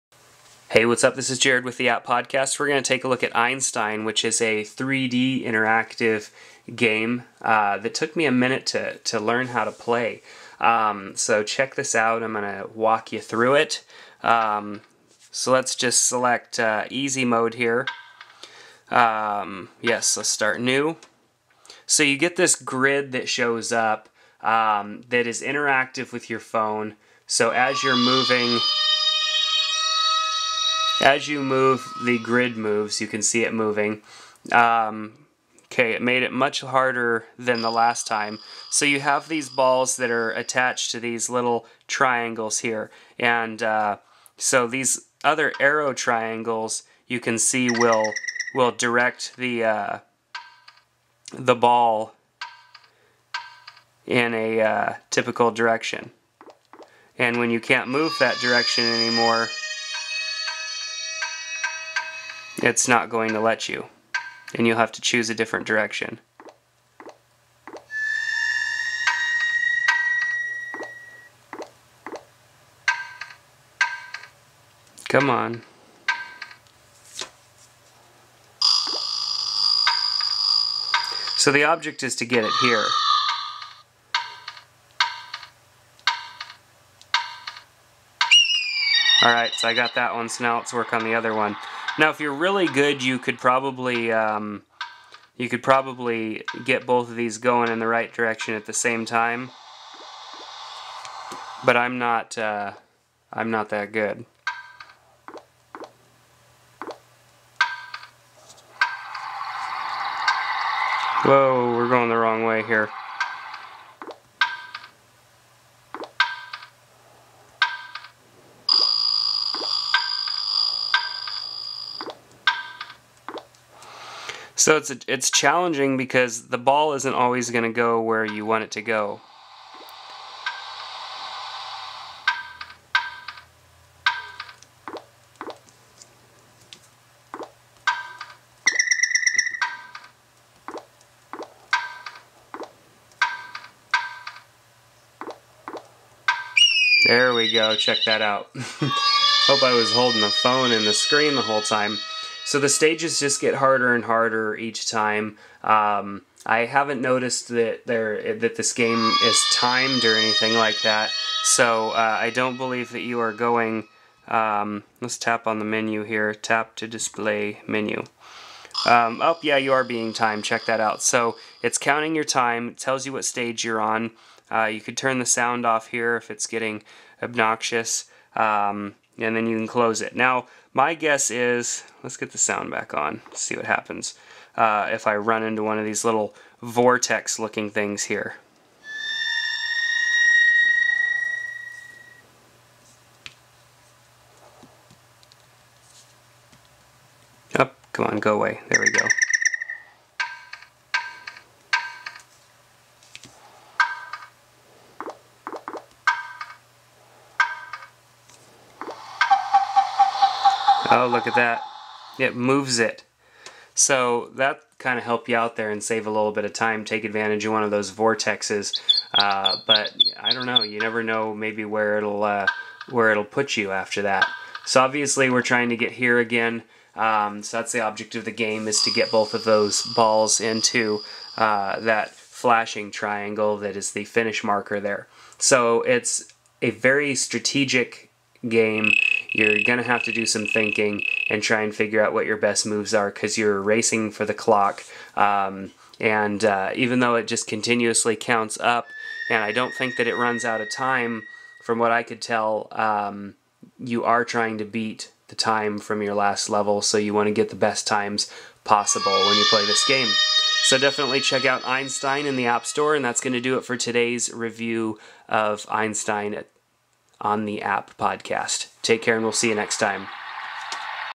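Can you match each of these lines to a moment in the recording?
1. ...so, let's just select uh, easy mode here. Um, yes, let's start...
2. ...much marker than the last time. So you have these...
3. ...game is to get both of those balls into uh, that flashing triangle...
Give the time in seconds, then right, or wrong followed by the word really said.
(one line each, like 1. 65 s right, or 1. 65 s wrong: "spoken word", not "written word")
1. 15 s right
2. 36 s wrong: "harder", not "marker"
3. 228 s right.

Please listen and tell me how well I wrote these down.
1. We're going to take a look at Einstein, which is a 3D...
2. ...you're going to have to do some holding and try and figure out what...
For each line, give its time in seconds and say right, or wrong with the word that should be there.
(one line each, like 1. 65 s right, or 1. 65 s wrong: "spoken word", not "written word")
1. 2 s right
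2. 239 s wrong: "thinking", not "holding".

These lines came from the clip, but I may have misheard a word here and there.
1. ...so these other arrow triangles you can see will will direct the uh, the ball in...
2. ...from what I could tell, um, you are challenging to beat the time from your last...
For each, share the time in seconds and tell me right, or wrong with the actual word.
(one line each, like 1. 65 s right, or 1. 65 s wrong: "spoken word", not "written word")
1. 44 s right
2. 251 s wrong: "trying", not "challenging".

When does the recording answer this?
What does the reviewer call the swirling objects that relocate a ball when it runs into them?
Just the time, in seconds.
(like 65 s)
217 s.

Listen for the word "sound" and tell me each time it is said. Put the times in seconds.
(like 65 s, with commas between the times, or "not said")
175 s, 182 s.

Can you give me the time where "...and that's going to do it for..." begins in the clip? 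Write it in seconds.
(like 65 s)
262 s.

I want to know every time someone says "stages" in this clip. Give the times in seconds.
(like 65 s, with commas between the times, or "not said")
152 s, 173 s.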